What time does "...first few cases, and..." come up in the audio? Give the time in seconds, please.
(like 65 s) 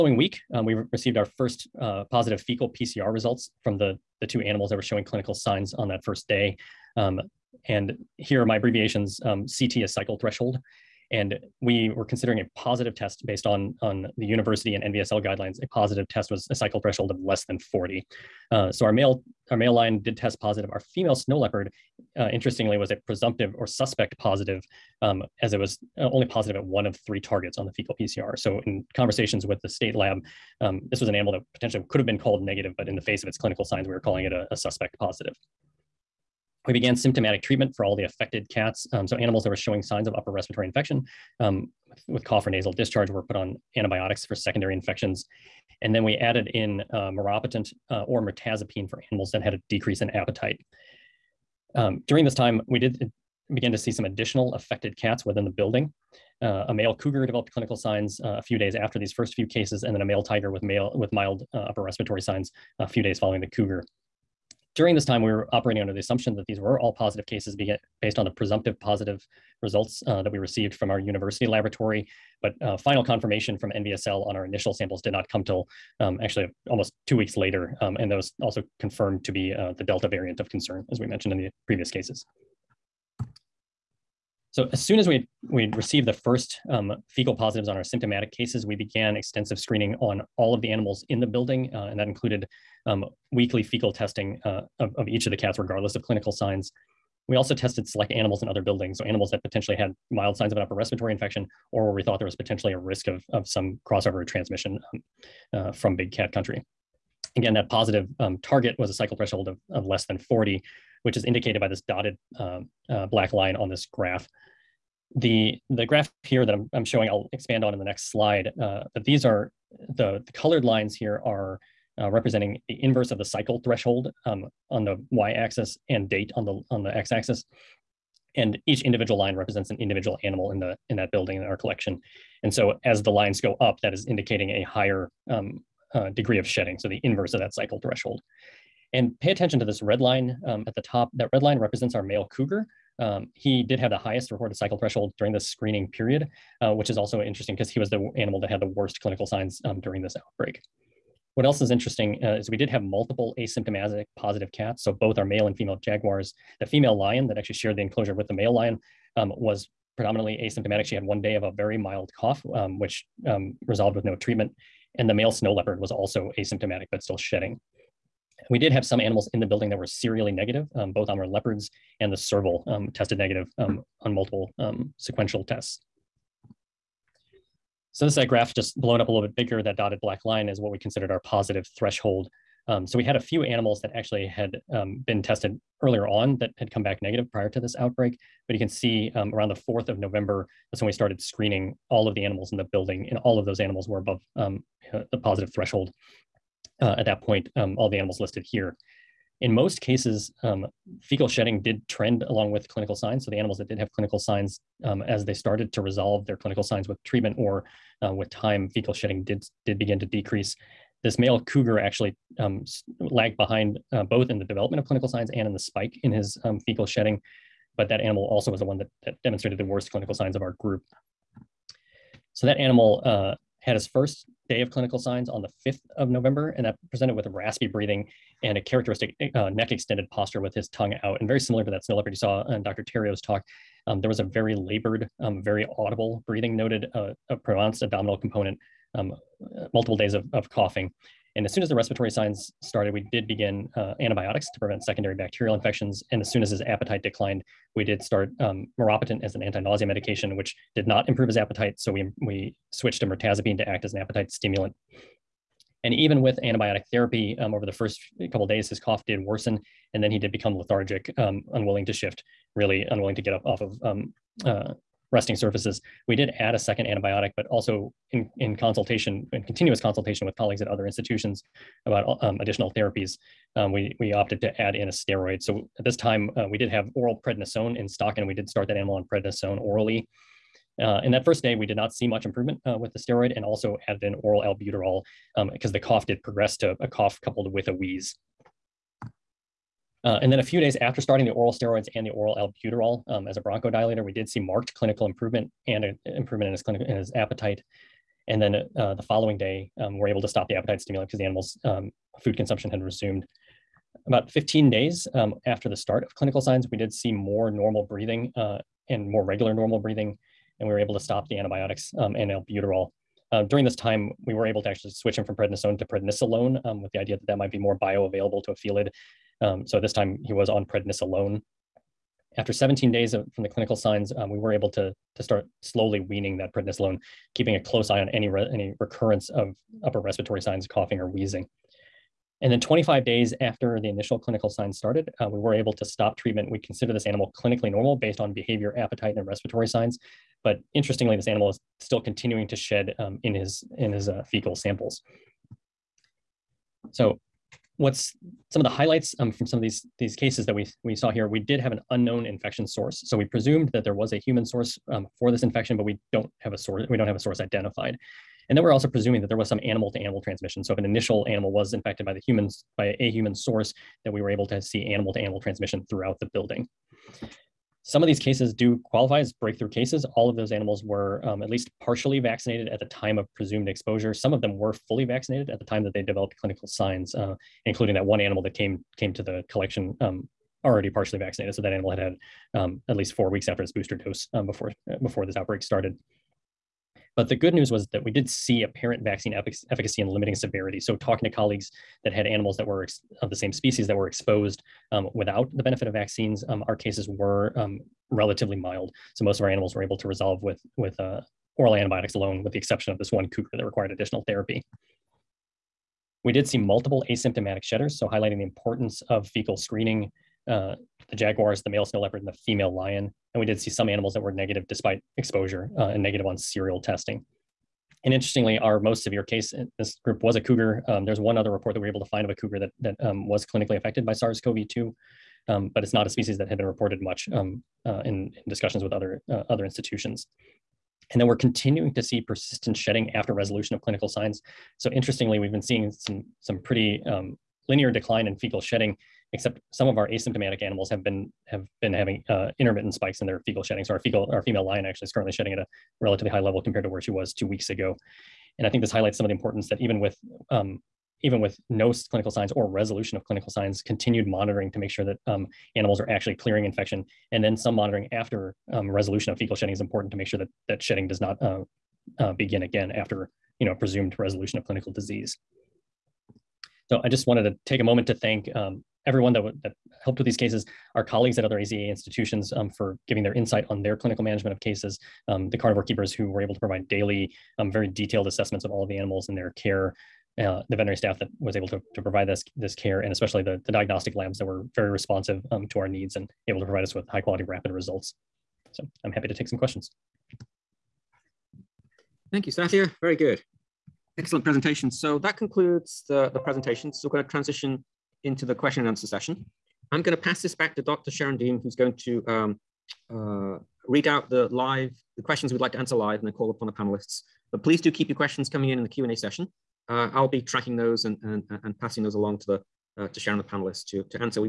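59 s.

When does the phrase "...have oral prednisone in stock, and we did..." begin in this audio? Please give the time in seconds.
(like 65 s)
276 s.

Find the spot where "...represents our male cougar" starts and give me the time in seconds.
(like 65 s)
141 s.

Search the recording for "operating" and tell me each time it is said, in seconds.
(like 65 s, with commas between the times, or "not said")
65 s.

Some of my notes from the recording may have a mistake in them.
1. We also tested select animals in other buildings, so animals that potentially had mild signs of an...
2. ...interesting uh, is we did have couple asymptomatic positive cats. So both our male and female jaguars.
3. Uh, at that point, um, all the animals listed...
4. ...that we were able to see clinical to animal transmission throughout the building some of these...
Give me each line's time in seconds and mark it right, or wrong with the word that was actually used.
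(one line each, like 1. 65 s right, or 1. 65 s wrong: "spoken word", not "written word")
1. 97 s right
2. 151 s wrong: "multiple", not "couple"
3. 196 s right
4. 364 s wrong: "animal", not "clinical".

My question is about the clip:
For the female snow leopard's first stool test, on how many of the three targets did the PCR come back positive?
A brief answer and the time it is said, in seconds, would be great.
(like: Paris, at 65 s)
1 of 3, at 26 s.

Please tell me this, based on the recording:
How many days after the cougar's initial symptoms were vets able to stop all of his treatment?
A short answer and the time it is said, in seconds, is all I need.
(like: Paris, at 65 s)
25 days, at 332 s.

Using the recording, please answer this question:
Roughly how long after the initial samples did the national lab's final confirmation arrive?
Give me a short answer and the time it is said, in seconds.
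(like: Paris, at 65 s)
almost two weeks, at 76 s.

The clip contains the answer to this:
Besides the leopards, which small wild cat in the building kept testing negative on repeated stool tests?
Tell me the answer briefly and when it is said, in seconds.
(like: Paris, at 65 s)
serval, at 172 s.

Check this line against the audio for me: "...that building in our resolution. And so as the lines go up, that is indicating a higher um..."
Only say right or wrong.
wrong.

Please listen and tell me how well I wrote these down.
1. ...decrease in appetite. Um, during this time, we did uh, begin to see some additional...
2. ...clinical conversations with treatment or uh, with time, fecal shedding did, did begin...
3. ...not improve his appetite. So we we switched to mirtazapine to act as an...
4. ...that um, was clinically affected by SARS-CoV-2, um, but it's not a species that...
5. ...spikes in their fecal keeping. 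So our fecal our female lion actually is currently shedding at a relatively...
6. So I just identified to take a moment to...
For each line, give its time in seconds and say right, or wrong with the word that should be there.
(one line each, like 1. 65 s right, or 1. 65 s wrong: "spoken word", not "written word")
1. 49 s right
2. 206 s wrong: "signs", not "conversations"
3. 250 s right
4. 422 s right
5. 442 s wrong: "shedding", not "keeping"
6. 466 s wrong: "wanted", not "identified".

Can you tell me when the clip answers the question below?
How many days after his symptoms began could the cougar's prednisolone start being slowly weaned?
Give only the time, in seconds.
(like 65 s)
322 s.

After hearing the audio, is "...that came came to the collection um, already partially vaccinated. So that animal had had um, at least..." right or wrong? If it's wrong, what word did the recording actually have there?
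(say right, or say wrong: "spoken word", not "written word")
right.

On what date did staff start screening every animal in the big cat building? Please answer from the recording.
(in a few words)
4th of November.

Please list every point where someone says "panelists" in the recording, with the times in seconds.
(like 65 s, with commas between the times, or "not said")
506 s, 513 s.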